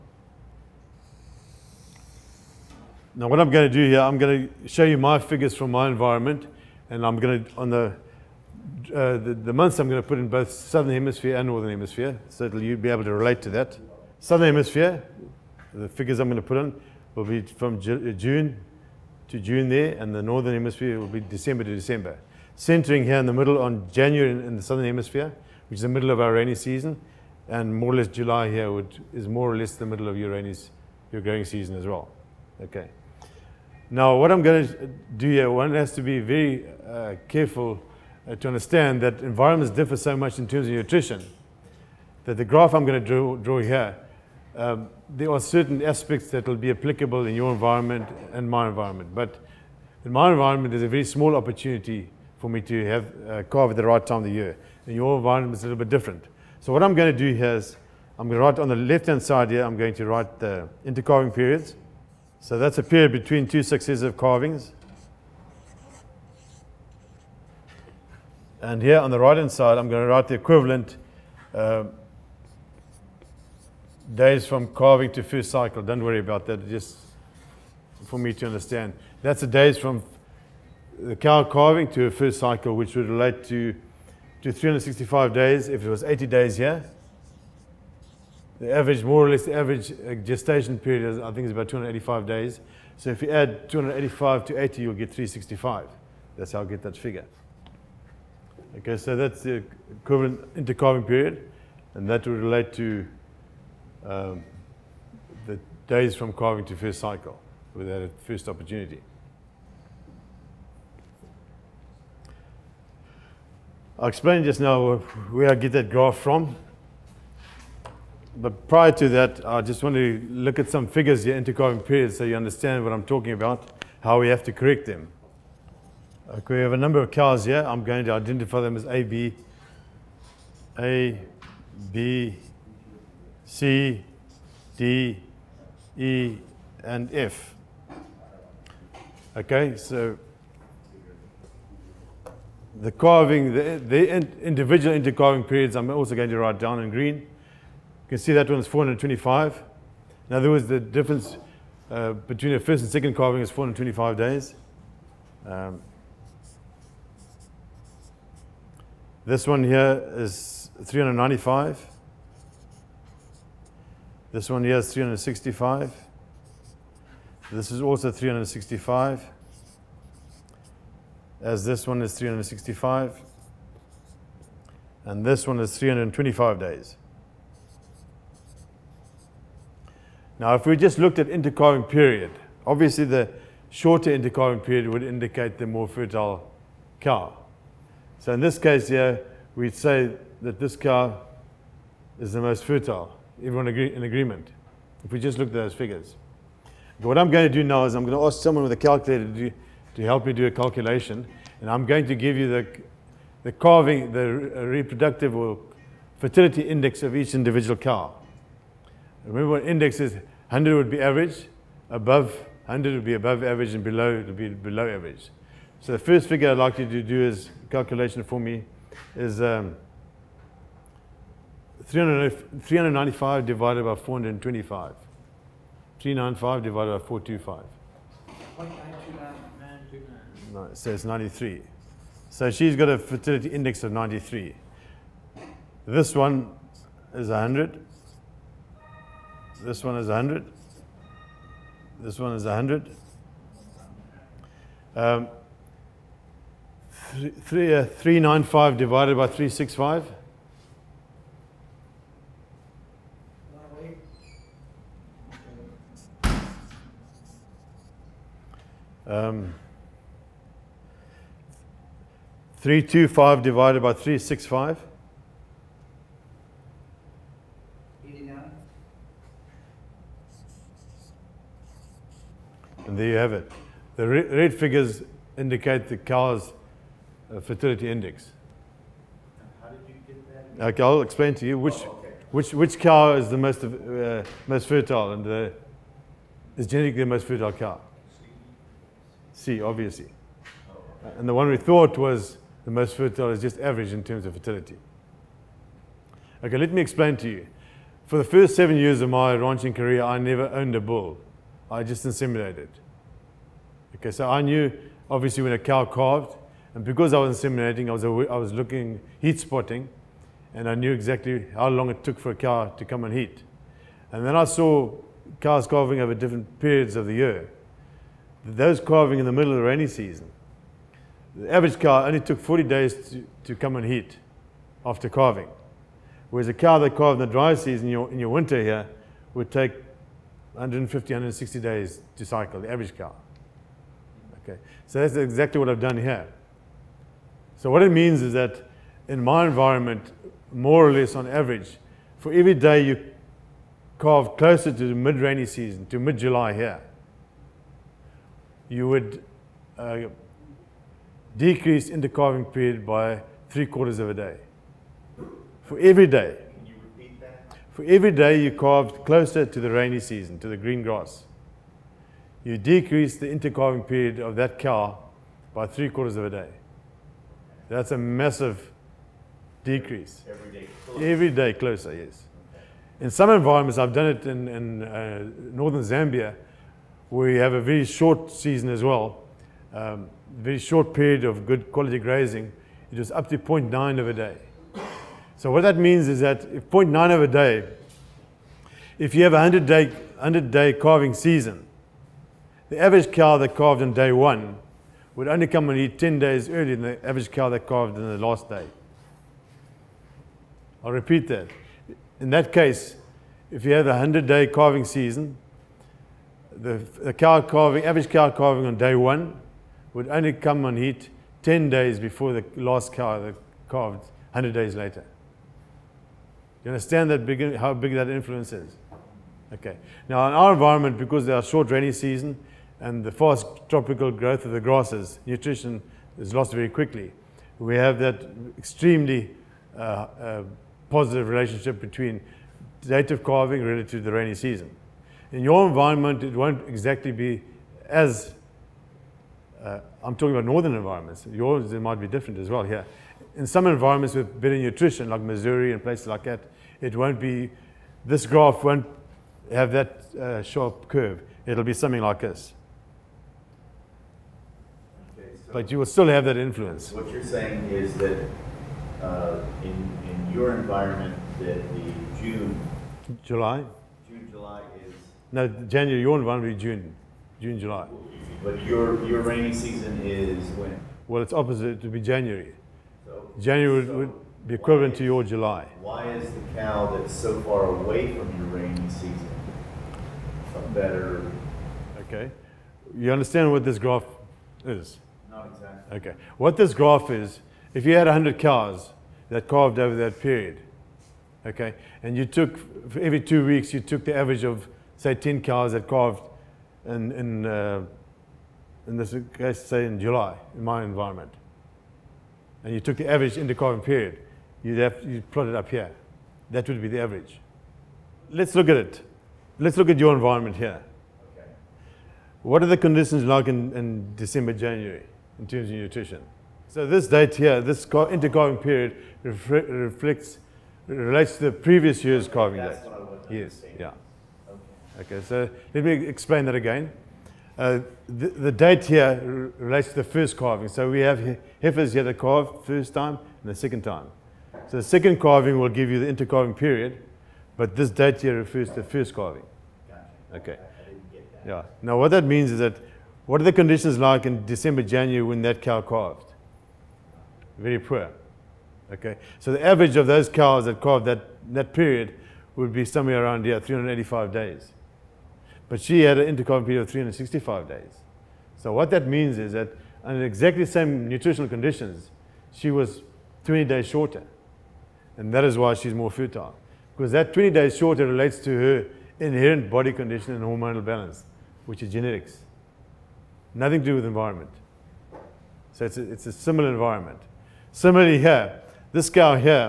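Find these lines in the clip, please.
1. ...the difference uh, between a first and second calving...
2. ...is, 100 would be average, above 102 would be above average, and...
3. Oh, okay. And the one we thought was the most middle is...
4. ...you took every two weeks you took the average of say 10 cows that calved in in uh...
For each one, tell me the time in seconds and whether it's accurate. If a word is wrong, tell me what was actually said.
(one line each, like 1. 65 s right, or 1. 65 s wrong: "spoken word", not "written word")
1. 150 s right
2. 209 s wrong: "100", not "102"
3. 290 s wrong: "fertile", not "middle"
4. 492 s right.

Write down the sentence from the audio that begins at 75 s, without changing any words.
Don't worry about that, just for me to understand.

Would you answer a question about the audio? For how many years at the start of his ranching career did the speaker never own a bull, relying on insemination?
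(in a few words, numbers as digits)
7.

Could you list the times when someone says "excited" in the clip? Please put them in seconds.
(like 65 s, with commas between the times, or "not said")
not said.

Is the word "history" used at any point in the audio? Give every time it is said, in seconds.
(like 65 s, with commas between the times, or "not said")
not said.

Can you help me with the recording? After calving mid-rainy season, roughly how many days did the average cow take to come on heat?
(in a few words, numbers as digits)
40.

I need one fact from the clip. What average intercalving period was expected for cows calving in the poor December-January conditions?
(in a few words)
385 days.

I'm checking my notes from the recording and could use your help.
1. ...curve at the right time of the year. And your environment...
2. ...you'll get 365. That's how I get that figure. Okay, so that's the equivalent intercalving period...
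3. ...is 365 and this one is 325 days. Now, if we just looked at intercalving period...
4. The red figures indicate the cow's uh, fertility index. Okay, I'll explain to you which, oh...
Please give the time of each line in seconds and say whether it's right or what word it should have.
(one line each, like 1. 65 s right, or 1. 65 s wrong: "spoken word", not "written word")
1. 53 s wrong: "calve", not "curve"
2. 94 s right
3. 172 s right
4. 273 s right.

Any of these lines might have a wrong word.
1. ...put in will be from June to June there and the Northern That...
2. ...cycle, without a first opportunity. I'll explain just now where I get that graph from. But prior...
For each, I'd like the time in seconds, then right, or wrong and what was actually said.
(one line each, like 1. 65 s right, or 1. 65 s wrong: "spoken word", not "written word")
1. 16 s wrong: "Hemisphere", not "That"
2. 106 s right.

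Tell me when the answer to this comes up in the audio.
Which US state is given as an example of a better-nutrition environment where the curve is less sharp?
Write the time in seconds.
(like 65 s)
445 s.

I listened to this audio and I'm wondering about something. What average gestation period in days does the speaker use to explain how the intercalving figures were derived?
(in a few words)
285.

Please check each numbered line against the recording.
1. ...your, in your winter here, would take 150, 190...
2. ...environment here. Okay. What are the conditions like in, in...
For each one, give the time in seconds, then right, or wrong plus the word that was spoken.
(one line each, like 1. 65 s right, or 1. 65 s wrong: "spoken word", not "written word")
1. 327 s wrong: "160", not "190"
2. 510 s right.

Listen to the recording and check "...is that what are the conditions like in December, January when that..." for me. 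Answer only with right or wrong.
right.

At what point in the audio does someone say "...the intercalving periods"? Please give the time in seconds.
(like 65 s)
60 s.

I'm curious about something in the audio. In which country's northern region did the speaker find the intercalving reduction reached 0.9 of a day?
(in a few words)
Zambia.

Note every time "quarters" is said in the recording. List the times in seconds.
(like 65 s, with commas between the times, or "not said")
353 s, 365 s.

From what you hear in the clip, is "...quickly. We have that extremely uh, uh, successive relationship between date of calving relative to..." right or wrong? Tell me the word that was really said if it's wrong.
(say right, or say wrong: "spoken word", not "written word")
wrong: "positive", not "successive".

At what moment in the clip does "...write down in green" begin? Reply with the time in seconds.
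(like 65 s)
146 s.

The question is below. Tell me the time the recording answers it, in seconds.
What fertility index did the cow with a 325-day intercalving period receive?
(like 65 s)
268 s.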